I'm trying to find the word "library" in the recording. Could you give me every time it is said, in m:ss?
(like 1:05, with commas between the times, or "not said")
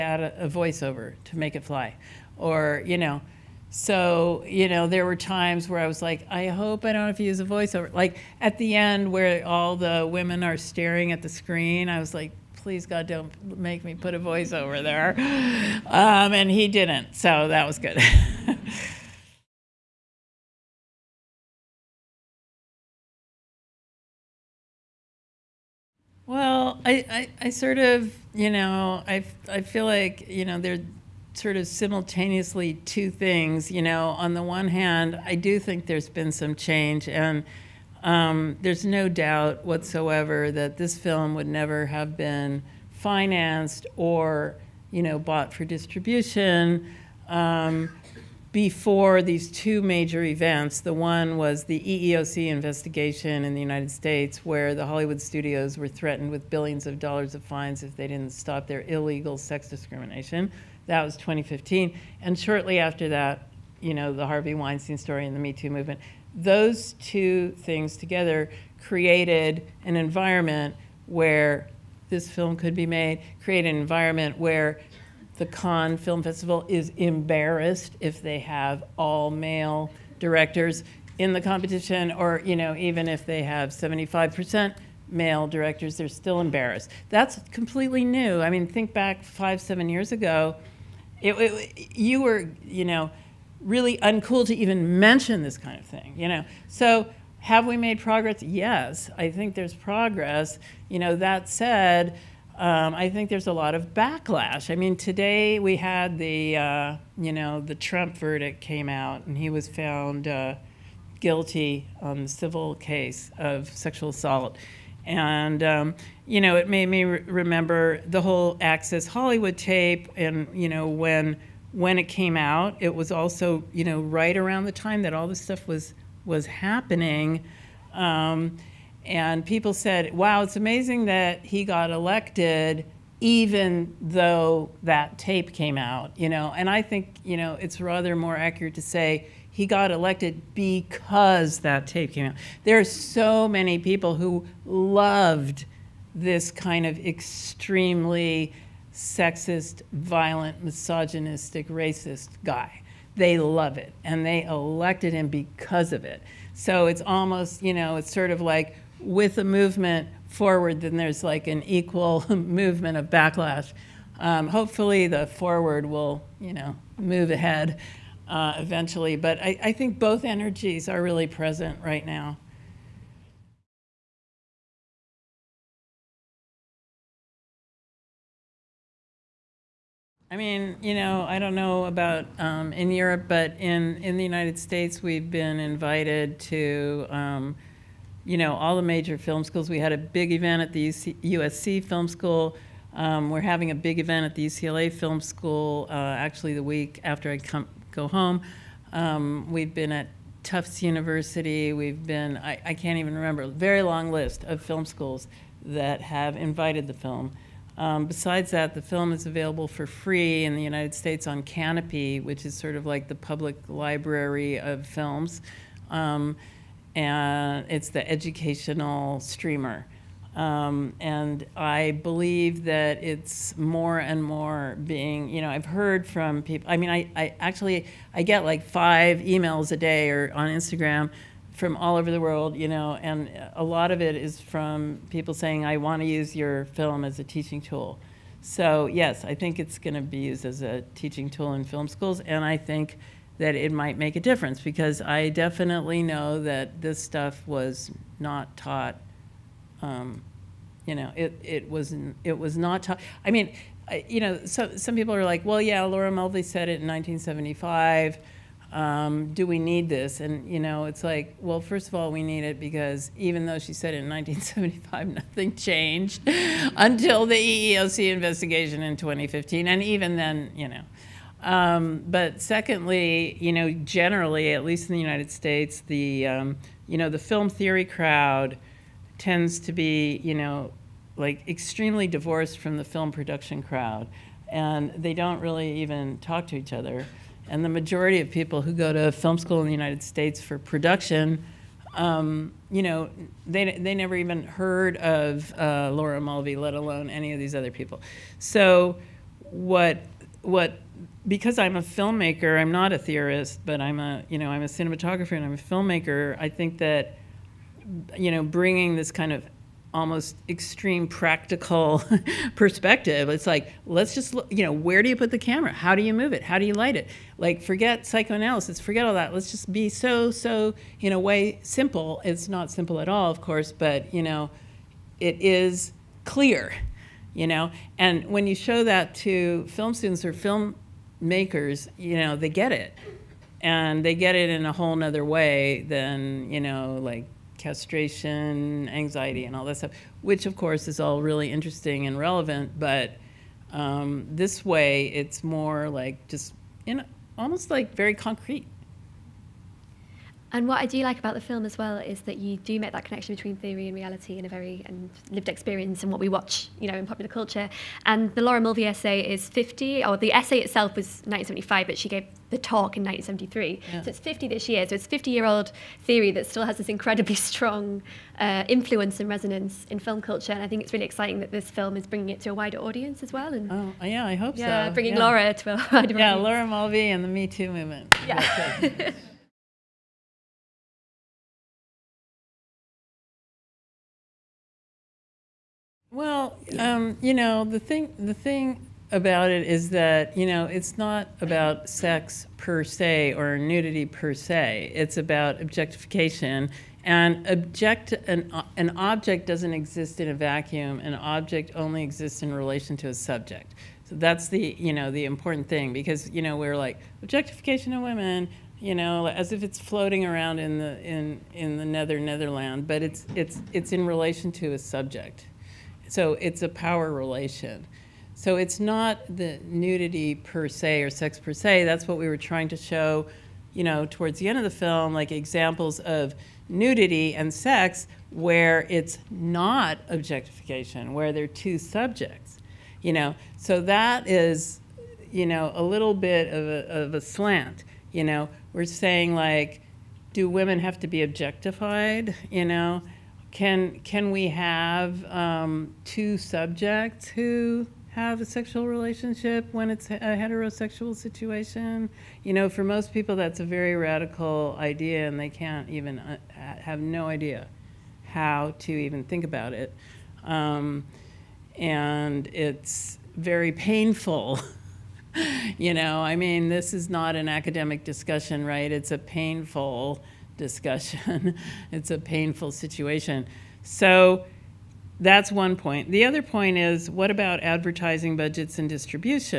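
3:33.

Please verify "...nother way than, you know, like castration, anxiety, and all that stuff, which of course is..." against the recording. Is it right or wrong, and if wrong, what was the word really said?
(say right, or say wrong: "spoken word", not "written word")
right.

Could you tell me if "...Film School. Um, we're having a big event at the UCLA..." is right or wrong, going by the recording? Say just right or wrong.
right.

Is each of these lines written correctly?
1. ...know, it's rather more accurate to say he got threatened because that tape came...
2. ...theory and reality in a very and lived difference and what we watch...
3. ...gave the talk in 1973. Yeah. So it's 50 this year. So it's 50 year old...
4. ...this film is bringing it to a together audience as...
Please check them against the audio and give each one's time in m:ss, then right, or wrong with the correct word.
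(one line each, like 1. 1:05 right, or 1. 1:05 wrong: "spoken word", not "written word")
1. 2:17 wrong: "elected", not "threatened"
2. 5:53 wrong: "experience", not "difference"
3. 6:02 right
4. 6:11 wrong: "wider", not "together".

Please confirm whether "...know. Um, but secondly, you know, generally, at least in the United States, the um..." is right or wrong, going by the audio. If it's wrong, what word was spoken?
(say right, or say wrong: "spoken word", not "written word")
right.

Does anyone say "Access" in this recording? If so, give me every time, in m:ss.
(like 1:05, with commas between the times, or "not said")
1:58.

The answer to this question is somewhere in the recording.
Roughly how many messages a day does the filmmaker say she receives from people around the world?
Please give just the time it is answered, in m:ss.
3:48.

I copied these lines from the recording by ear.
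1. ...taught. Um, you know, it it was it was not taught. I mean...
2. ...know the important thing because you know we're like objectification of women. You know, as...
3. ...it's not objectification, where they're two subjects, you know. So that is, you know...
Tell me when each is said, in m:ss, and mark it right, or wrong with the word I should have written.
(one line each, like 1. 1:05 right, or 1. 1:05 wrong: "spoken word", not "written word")
1. 4:08 right
2. 6:44 right
3. 7:08 right.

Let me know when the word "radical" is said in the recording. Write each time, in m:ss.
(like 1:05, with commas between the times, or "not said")
7:33.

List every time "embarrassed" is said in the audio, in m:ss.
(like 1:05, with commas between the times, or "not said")
1:16, 1:26.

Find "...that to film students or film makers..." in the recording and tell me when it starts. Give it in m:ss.
5:28.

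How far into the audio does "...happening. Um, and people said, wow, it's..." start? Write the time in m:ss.
2:06.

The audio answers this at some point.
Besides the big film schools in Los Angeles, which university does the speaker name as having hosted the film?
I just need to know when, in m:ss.
3:20.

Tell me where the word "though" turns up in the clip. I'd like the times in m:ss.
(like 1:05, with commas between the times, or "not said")
2:13, 4:23.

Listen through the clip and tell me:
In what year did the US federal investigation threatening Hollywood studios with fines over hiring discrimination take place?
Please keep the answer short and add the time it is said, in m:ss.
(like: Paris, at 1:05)
2015, at 1:00.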